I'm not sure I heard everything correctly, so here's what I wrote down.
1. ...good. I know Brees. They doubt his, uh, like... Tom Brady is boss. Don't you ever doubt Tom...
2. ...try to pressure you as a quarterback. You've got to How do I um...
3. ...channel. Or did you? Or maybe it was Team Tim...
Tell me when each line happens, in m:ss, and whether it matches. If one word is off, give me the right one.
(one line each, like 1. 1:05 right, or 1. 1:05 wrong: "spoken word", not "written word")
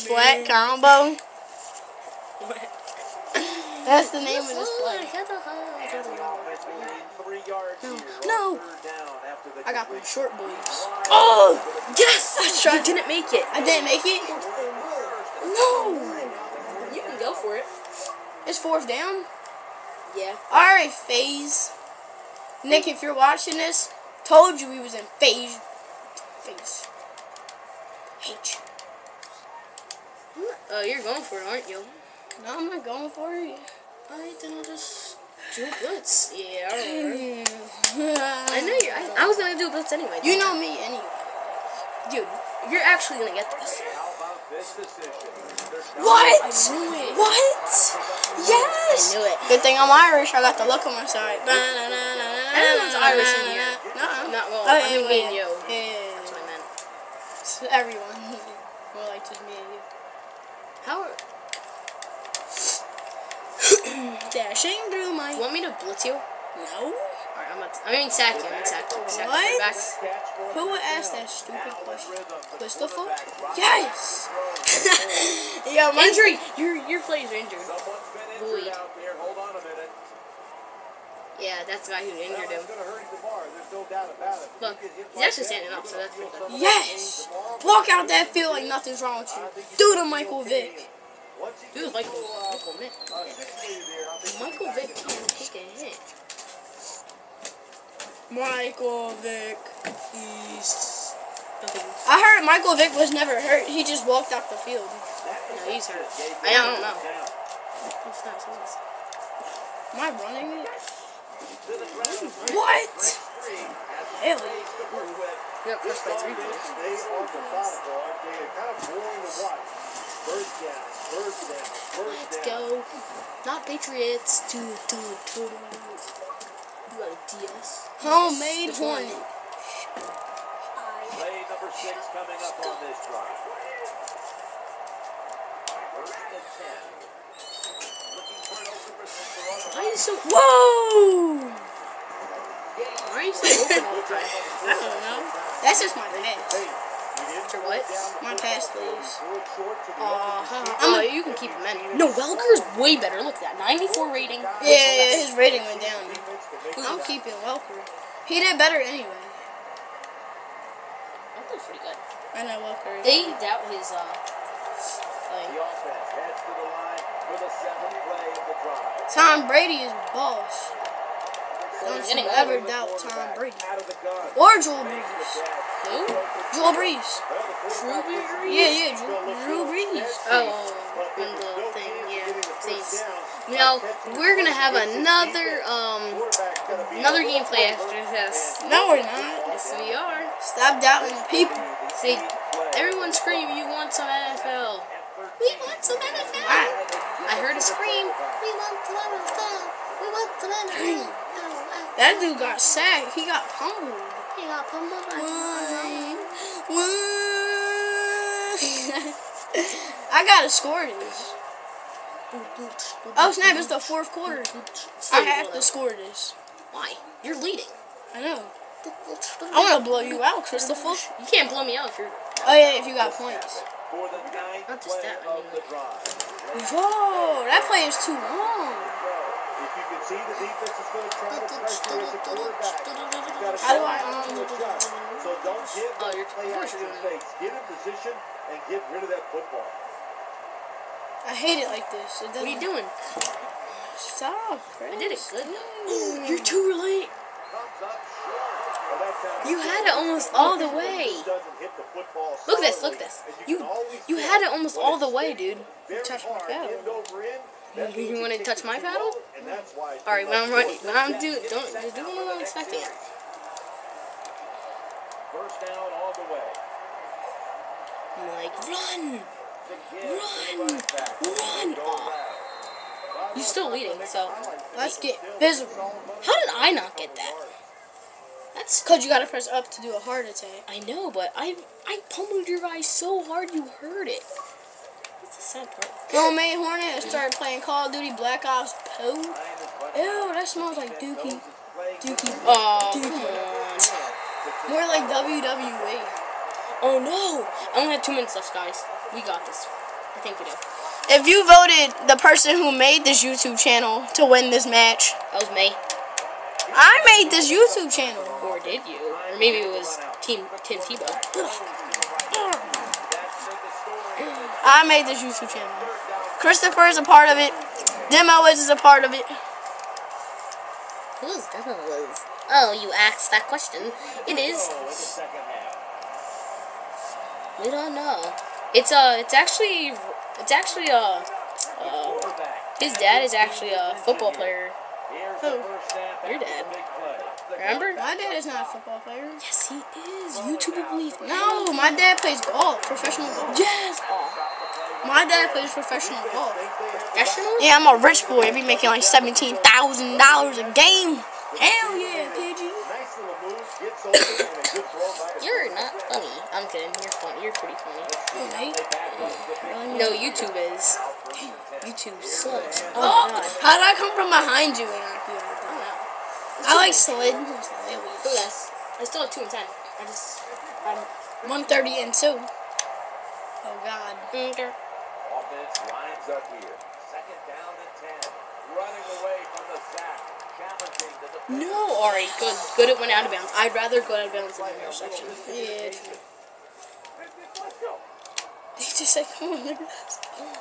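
1. 2:41 wrong: "Welker", not "Brees"
2. 3:51 right
3. 5:07 right.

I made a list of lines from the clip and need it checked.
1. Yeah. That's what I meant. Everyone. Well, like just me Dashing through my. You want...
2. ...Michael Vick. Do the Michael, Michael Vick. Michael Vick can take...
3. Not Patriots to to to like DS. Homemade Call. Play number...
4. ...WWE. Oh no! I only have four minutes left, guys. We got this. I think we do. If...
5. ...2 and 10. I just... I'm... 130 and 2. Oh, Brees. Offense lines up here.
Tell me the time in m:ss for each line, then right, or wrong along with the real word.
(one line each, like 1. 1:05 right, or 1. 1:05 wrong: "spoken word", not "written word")
1. 0:55 right
2. 1:30 right
3. 2:03 wrong: "Hornet", not "Call"
4. 4:55 wrong: "two", not "four"
5. 6:09 wrong: "God", not "Brees".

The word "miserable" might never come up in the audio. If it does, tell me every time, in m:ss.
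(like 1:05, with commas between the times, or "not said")
4:35.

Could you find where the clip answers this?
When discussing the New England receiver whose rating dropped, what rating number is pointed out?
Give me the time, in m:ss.
2:33.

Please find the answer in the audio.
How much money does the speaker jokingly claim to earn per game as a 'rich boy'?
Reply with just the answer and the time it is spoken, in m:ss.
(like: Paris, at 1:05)
$17,000, at 5:49.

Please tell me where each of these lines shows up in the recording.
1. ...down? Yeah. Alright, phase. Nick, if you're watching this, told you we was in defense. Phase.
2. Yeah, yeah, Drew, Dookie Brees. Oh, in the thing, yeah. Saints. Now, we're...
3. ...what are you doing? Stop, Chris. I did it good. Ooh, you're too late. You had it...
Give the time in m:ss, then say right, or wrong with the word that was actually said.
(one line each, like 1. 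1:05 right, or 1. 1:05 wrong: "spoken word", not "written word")
1. 0:18 wrong: "phase", not "defense"
2. 2:58 wrong: "Drew", not "Dookie"
3. 4:02 right.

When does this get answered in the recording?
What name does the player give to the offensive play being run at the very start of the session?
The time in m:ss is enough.
0:00.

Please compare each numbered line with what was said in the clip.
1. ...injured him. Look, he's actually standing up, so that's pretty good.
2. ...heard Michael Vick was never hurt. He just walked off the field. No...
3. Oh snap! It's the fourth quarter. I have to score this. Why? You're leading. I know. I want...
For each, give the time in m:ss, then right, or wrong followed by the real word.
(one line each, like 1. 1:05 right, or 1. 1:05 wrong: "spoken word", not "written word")
1. 1:22 right
2. 1:42 right
3. 3:33 right.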